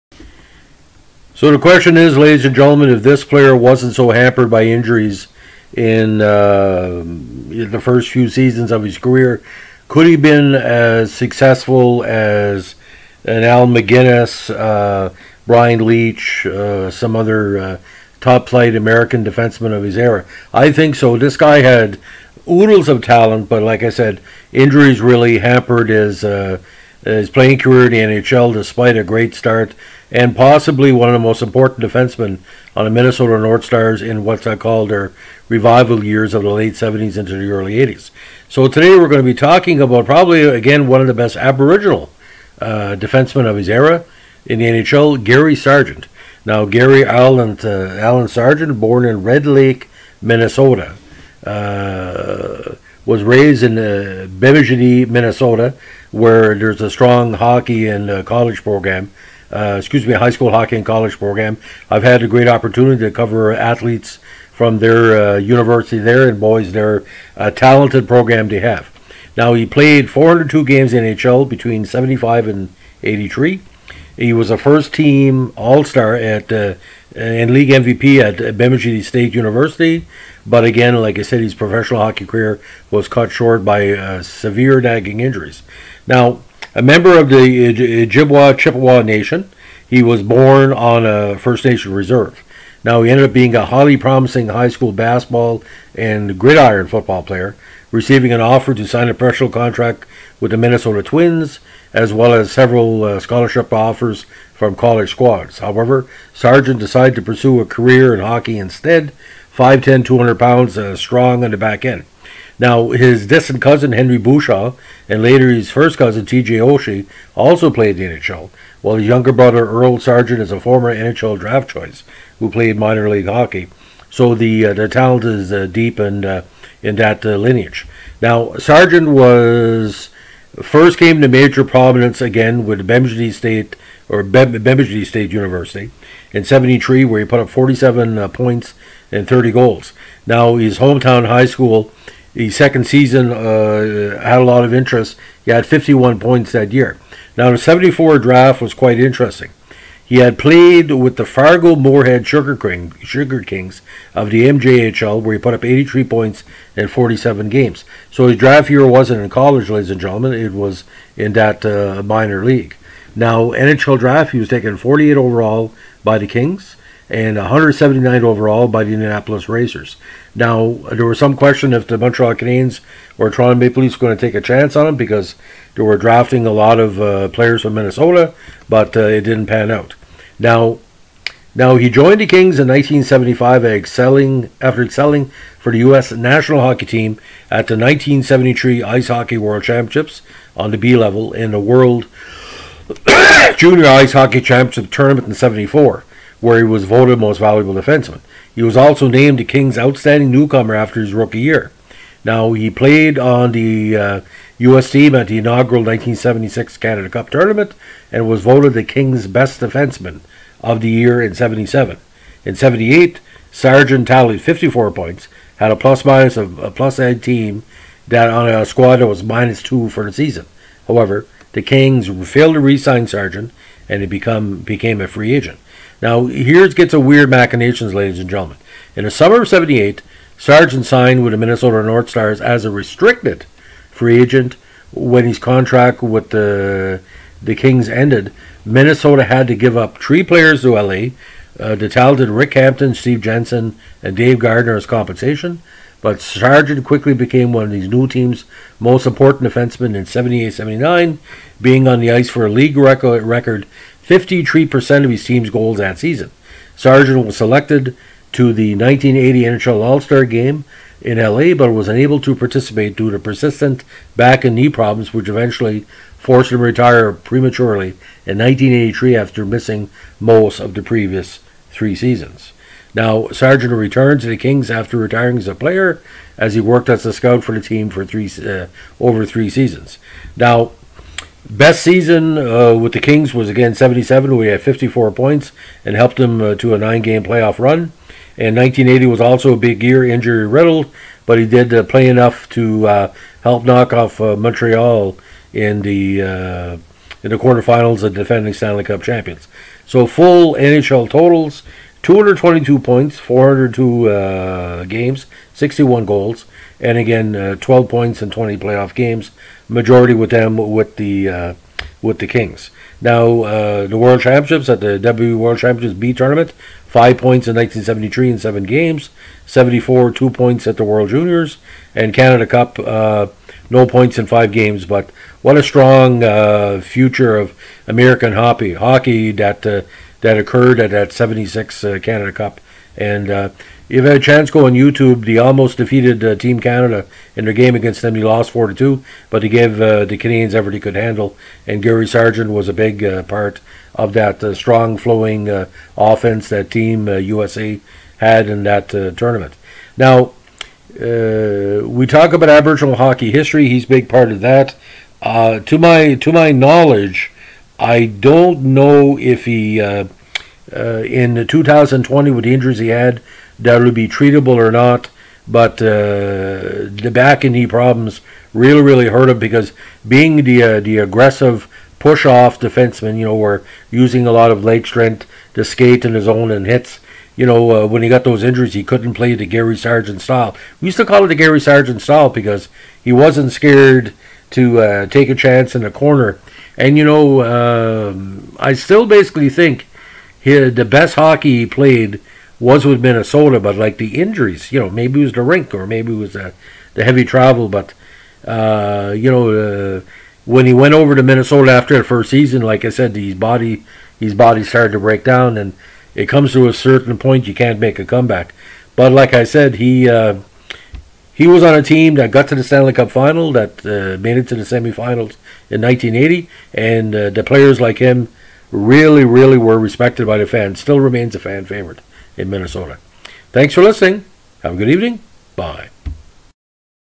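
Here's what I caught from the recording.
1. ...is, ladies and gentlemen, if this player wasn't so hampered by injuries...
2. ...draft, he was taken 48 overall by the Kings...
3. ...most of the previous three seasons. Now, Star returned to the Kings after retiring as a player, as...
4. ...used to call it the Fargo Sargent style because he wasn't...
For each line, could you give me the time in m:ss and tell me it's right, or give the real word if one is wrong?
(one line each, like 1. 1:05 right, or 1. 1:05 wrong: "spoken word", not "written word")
1. 0:01 right
2. 2:43 right
3. 4:30 wrong: "Sargent", not "Star"
4. 6:20 wrong: "Gary", not "Fargo".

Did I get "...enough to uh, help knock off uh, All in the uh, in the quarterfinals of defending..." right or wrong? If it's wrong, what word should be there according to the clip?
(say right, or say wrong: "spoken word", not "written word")
wrong: "Montreal", not "All".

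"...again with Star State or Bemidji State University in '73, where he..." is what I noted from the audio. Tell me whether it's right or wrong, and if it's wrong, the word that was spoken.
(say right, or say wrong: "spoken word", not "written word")
wrong: "Bemidji", not "Star".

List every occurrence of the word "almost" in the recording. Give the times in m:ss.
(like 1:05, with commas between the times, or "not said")
5:35.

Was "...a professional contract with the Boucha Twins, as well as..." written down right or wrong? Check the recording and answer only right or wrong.
wrong.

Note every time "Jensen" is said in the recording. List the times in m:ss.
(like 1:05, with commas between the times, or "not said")
4:03.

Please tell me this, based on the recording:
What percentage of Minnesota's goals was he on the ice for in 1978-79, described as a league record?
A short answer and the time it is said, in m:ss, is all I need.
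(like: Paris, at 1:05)
53%, at 4:14.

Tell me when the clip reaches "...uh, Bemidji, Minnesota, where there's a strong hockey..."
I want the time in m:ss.
0:53.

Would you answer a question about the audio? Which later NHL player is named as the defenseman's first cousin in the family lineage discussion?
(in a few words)
T.J. Oshie.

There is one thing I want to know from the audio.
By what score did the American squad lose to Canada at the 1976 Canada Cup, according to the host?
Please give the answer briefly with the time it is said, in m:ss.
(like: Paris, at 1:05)
4 to 2, at 5:38.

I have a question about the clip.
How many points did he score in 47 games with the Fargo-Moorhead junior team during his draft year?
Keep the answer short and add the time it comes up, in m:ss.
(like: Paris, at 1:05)
83, at 2:35.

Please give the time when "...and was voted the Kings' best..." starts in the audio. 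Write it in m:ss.
3:28.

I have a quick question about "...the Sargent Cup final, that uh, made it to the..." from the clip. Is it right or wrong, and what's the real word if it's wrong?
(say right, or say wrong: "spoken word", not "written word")
wrong: "Stanley", not "Sargent".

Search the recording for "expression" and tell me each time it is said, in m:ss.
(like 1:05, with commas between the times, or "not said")
not said.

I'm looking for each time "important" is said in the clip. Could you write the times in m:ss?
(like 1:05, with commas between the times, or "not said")
0:31, 4:09.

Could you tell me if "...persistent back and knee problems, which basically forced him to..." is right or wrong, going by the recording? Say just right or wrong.
wrong.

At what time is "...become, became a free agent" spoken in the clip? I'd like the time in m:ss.
3:44.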